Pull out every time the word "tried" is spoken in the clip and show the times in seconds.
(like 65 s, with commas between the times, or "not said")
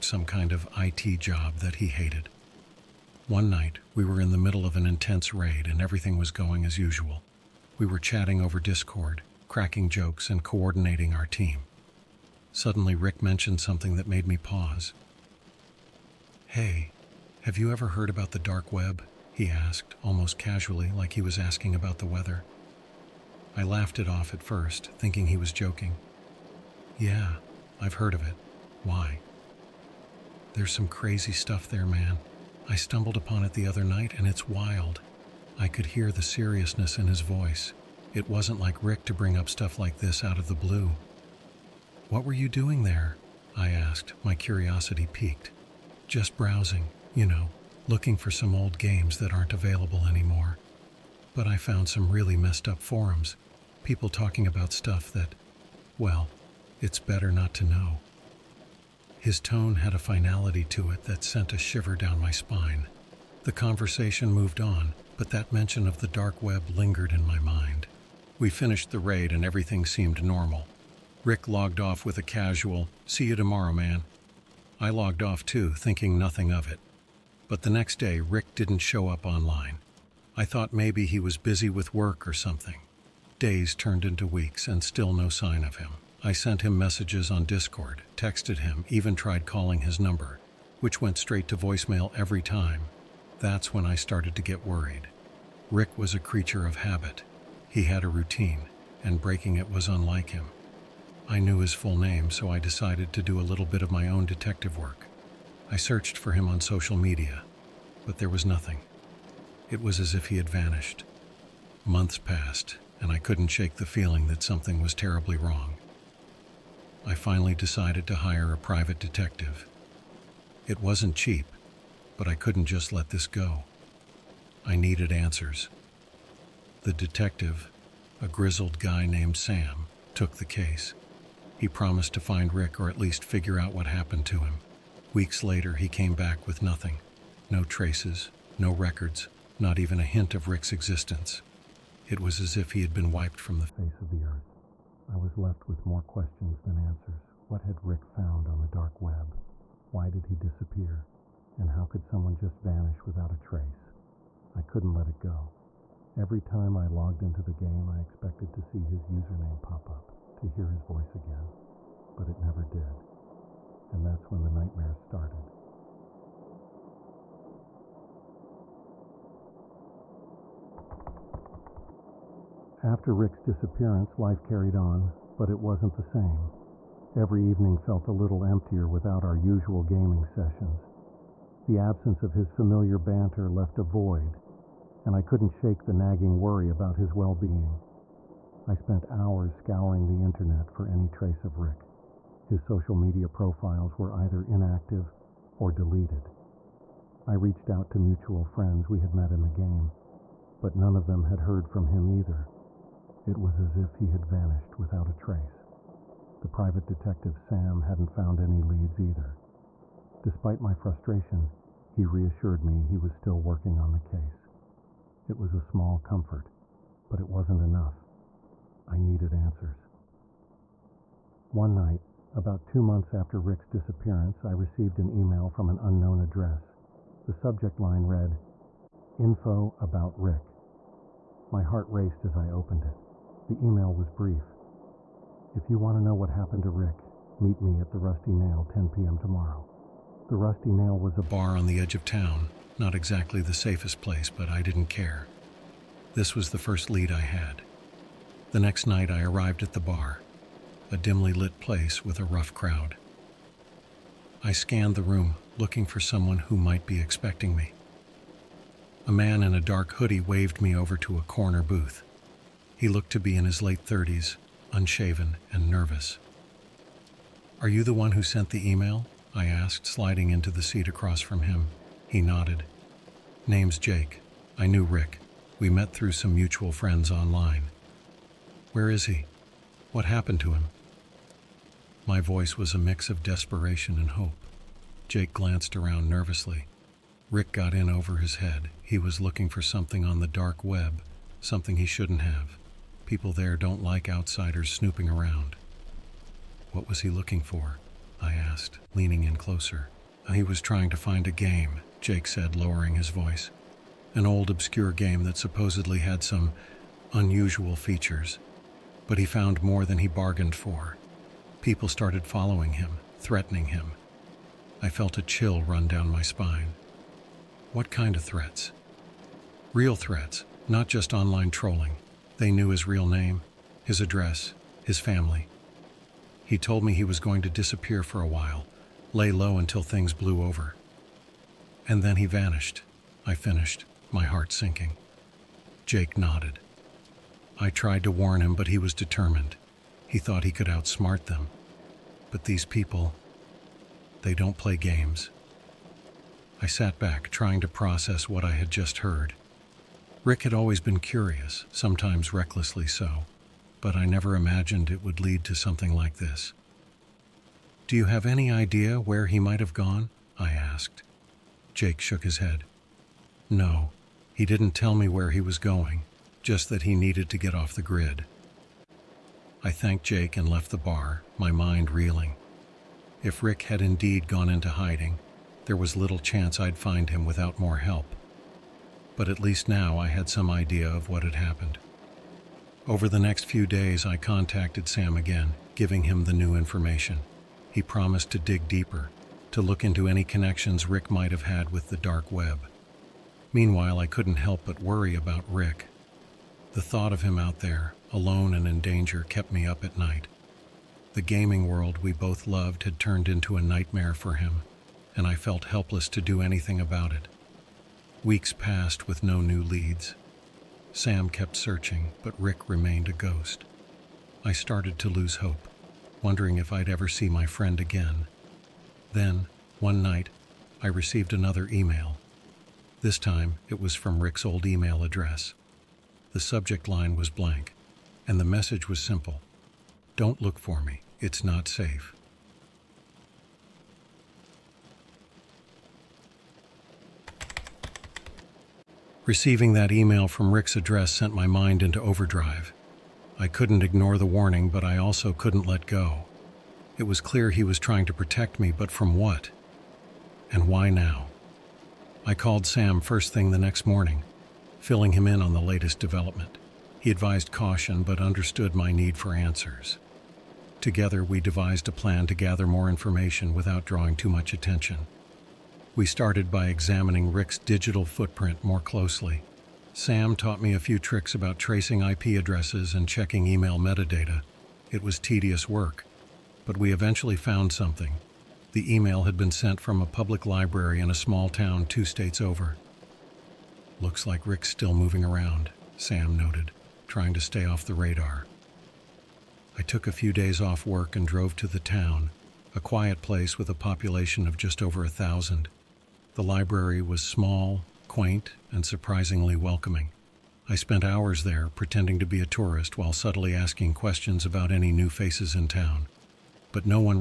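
89 s, 337 s.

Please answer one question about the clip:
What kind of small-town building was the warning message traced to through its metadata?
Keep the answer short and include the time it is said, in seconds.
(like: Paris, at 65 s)
A public library, at 480 s.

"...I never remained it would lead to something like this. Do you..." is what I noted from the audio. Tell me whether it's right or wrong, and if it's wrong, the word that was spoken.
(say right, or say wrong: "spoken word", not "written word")
wrong: "imagined", not "remained".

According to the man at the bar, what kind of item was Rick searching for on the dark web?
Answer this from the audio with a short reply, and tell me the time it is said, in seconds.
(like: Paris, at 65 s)
An old obscure game, at 304 s.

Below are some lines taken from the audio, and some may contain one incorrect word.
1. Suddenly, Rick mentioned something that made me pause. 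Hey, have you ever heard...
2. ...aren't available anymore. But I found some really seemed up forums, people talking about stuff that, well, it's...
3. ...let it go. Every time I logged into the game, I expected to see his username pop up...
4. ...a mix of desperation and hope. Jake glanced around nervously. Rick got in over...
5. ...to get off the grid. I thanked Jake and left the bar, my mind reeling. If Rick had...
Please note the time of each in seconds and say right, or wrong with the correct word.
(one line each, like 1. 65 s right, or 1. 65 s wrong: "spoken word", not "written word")
1. 12 s right
2. 49 s wrong: "messed", not "seemed"
3. 154 s right
4. 282 s right
5. 367 s right.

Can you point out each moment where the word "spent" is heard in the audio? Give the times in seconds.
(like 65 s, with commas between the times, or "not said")
188 s, 500 s.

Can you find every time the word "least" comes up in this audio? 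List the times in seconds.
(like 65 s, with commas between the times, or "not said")
132 s, 379 s.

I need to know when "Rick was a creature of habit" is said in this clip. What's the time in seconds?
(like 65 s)
95 s.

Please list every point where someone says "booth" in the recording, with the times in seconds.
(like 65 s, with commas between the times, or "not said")
261 s.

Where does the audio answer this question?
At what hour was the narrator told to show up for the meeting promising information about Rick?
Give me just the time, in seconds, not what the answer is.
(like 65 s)
238 s.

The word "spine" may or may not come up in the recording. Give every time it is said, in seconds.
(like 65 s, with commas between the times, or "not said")
62 s, 316 s.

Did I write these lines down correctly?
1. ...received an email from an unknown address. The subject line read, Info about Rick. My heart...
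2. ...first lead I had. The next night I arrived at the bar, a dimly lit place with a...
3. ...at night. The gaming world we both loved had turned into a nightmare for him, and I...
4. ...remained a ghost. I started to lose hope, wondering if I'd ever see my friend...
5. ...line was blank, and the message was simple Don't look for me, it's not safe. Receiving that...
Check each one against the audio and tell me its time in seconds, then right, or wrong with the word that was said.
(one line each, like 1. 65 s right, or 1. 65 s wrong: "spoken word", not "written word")
1. 224 s right
2. 246 s right
3. 399 s right
4. 412 s right
5. 426 s right.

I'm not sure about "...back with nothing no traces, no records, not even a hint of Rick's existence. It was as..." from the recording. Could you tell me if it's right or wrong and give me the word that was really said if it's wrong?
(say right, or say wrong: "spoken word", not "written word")
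right.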